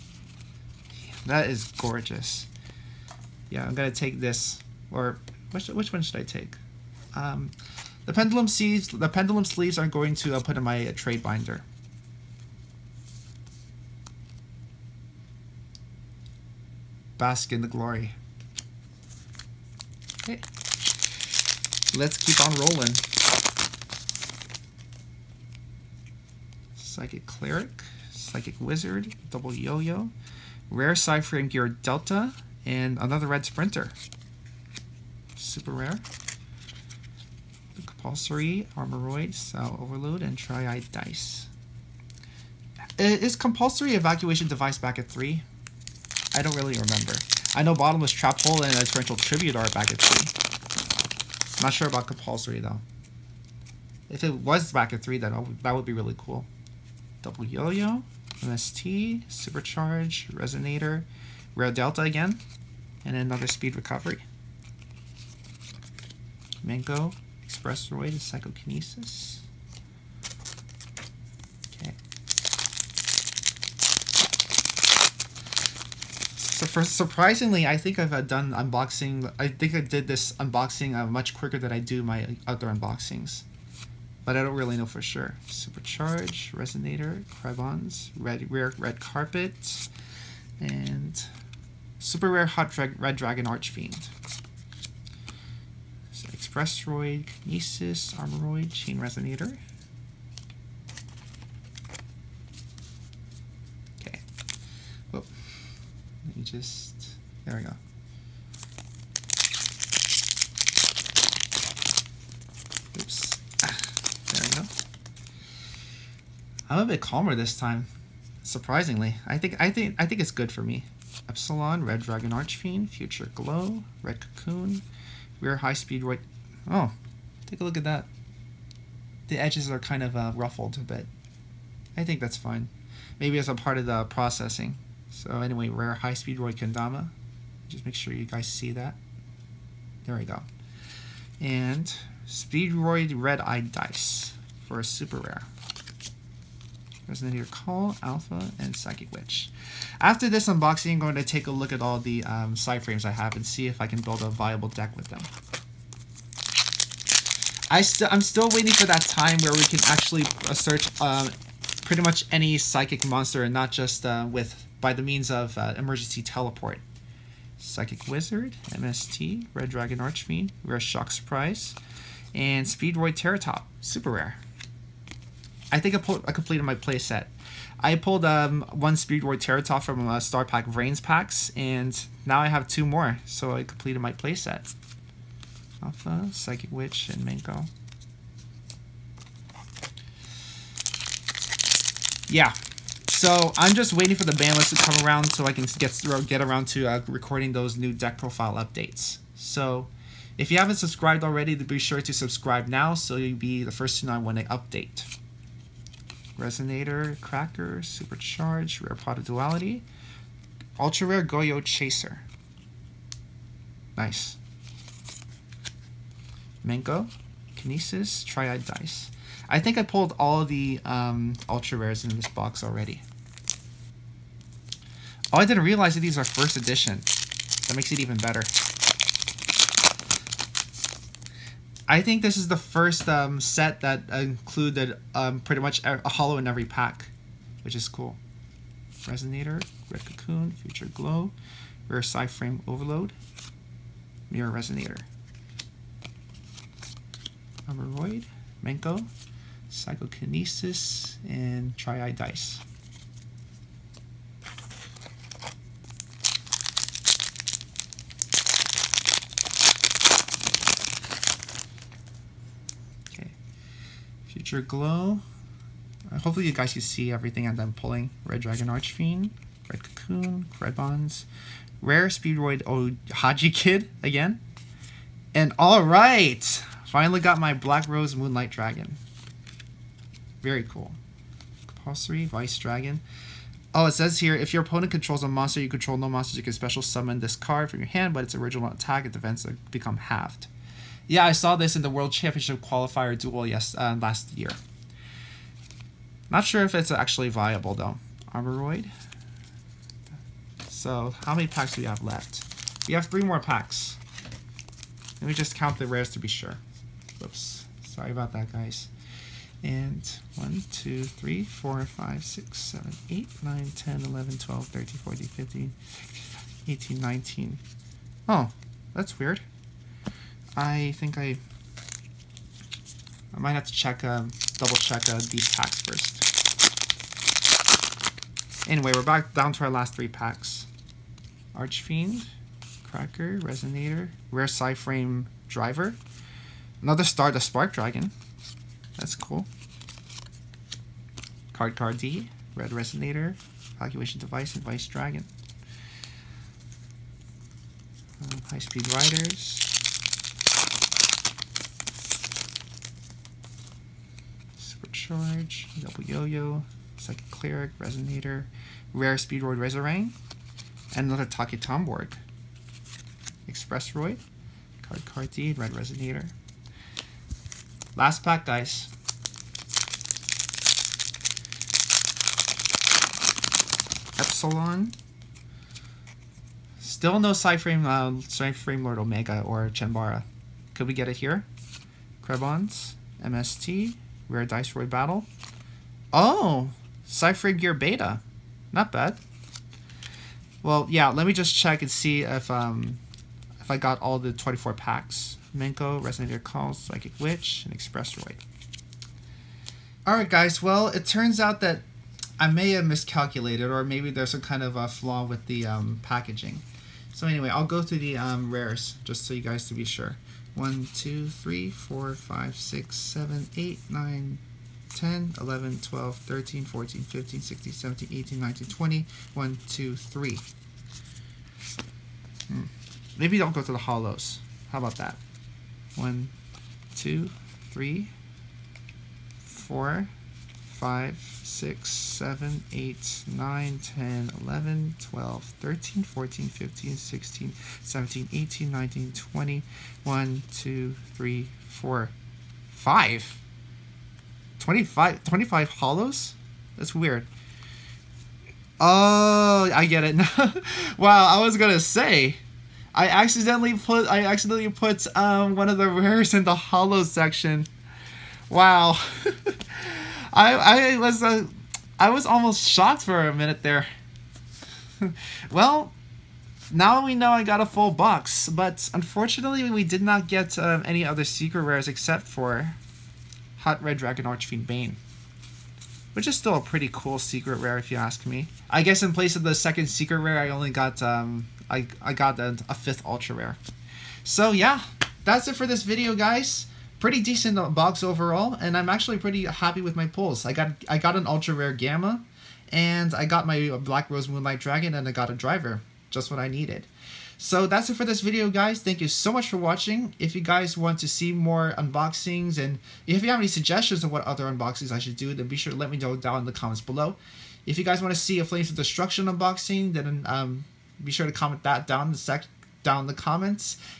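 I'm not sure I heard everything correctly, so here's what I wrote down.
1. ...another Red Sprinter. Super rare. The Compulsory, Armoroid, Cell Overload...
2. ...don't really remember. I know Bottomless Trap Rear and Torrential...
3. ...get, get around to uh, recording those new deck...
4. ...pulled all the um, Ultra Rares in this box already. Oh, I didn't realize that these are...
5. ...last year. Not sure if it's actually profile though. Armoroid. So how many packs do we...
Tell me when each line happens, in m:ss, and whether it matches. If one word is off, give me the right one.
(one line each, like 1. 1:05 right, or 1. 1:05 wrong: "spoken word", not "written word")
1. 0:32 right
2. 0:46 wrong: "Hole", not "Rear"
3. 3:15 right
4. 3:39 right
5. 4:54 wrong: "viable", not "profile".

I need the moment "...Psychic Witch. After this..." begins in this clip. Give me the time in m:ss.
2:28.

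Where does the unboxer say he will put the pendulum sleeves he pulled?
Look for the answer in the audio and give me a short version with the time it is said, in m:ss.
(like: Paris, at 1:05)
trade binder, at 0:10.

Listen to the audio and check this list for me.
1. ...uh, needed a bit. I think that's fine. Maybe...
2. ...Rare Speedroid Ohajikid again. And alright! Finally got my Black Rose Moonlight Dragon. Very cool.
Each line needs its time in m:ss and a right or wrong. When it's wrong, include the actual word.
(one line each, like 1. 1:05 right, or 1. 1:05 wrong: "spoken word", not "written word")
1. 2:10 wrong: "ruffled", not "needed"
2. 4:31 right.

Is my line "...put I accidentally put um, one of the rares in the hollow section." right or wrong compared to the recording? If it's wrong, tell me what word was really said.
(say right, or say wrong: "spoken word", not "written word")
right.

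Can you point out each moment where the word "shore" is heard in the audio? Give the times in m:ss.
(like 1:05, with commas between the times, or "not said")
not said.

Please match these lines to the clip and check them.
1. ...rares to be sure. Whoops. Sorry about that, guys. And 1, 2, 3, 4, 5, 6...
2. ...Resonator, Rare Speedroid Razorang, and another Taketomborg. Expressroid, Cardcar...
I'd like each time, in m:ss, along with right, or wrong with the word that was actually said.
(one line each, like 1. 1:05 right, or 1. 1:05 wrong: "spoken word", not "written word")
1. 5:05 right
2. 5:57 right.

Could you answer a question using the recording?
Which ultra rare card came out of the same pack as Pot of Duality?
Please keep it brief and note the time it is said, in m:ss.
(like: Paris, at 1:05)
Goyo Chaser, at 3:31.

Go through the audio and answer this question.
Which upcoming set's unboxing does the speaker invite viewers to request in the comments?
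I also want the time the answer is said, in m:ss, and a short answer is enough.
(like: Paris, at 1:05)
Flames of Destruction, at 8:28.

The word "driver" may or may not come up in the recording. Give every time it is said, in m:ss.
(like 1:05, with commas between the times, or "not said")
5:35, 8:15.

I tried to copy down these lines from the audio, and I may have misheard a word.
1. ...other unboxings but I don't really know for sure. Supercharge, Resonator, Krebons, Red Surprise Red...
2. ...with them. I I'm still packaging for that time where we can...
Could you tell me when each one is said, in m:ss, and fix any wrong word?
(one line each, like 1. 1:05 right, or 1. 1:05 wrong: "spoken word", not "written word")
1. 1:22 wrong: "Rare", not "Surprise"
2. 2:34 wrong: "waiting", not "packaging".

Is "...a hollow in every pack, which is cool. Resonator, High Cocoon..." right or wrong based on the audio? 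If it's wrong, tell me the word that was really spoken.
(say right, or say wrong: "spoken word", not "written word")
wrong: "Red", not "High".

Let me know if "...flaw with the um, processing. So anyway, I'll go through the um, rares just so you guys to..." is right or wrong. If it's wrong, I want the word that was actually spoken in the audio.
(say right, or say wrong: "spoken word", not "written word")
wrong: "packaging", not "processing".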